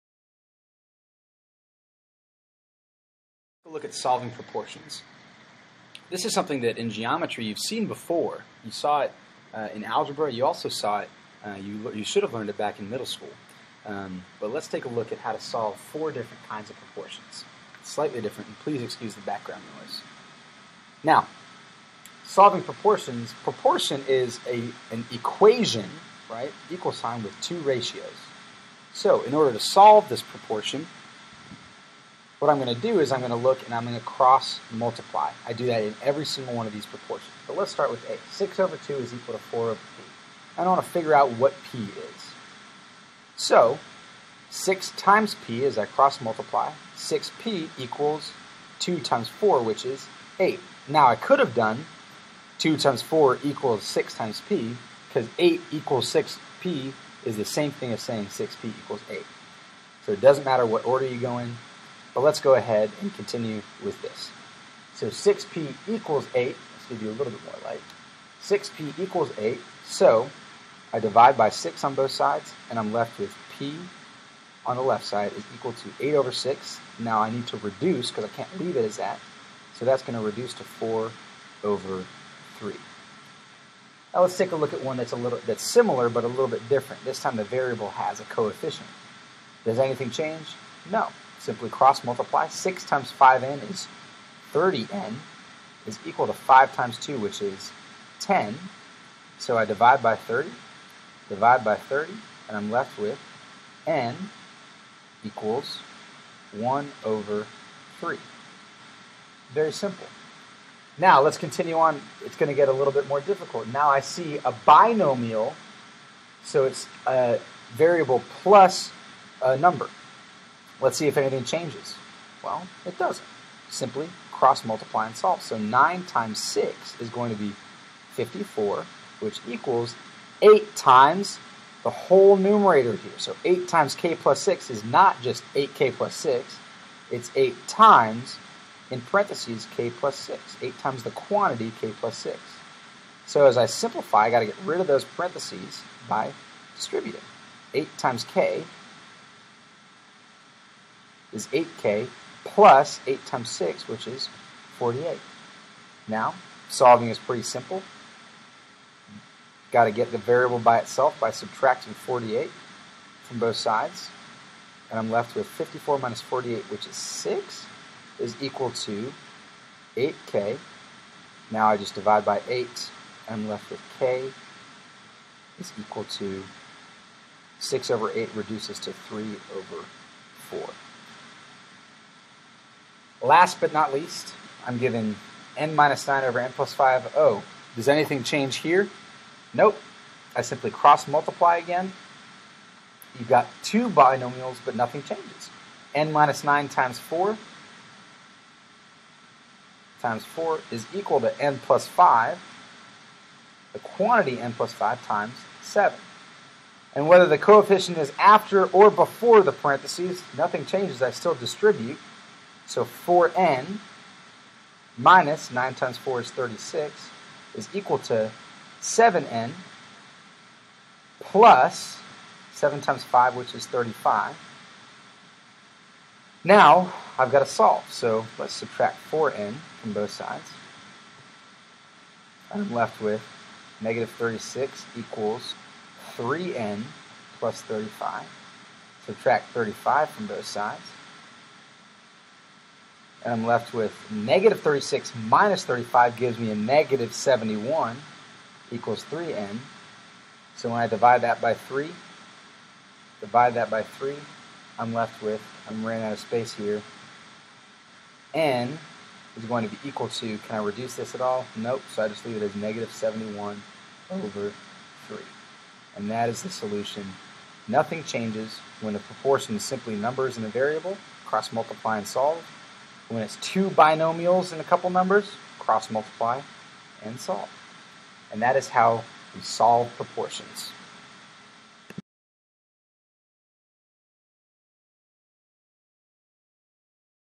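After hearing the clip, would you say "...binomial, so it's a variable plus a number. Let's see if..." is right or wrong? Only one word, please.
right.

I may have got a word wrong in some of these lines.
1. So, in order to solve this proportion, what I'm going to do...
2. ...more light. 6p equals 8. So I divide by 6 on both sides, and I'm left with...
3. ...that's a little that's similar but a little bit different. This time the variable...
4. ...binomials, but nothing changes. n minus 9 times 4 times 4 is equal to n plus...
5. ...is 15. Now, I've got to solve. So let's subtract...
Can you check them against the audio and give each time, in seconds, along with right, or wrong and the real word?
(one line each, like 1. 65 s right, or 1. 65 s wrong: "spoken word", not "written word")
1. 28 s right
2. 67 s right
3. 84 s right
4. 193 s right
5. 223 s wrong: "35", not "15".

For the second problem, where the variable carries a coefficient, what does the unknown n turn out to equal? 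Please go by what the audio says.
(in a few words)
1/3.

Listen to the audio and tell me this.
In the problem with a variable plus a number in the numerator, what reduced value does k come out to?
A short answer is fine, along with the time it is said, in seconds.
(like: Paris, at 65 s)
3/4, at 178 s.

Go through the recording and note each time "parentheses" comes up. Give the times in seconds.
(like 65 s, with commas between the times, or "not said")
139 s, 145 s, 209 s.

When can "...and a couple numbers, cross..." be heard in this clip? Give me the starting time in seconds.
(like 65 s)
274 s.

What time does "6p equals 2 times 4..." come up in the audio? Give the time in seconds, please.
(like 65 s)
46 s.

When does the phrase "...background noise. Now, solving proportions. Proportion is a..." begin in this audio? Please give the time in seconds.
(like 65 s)
19 s.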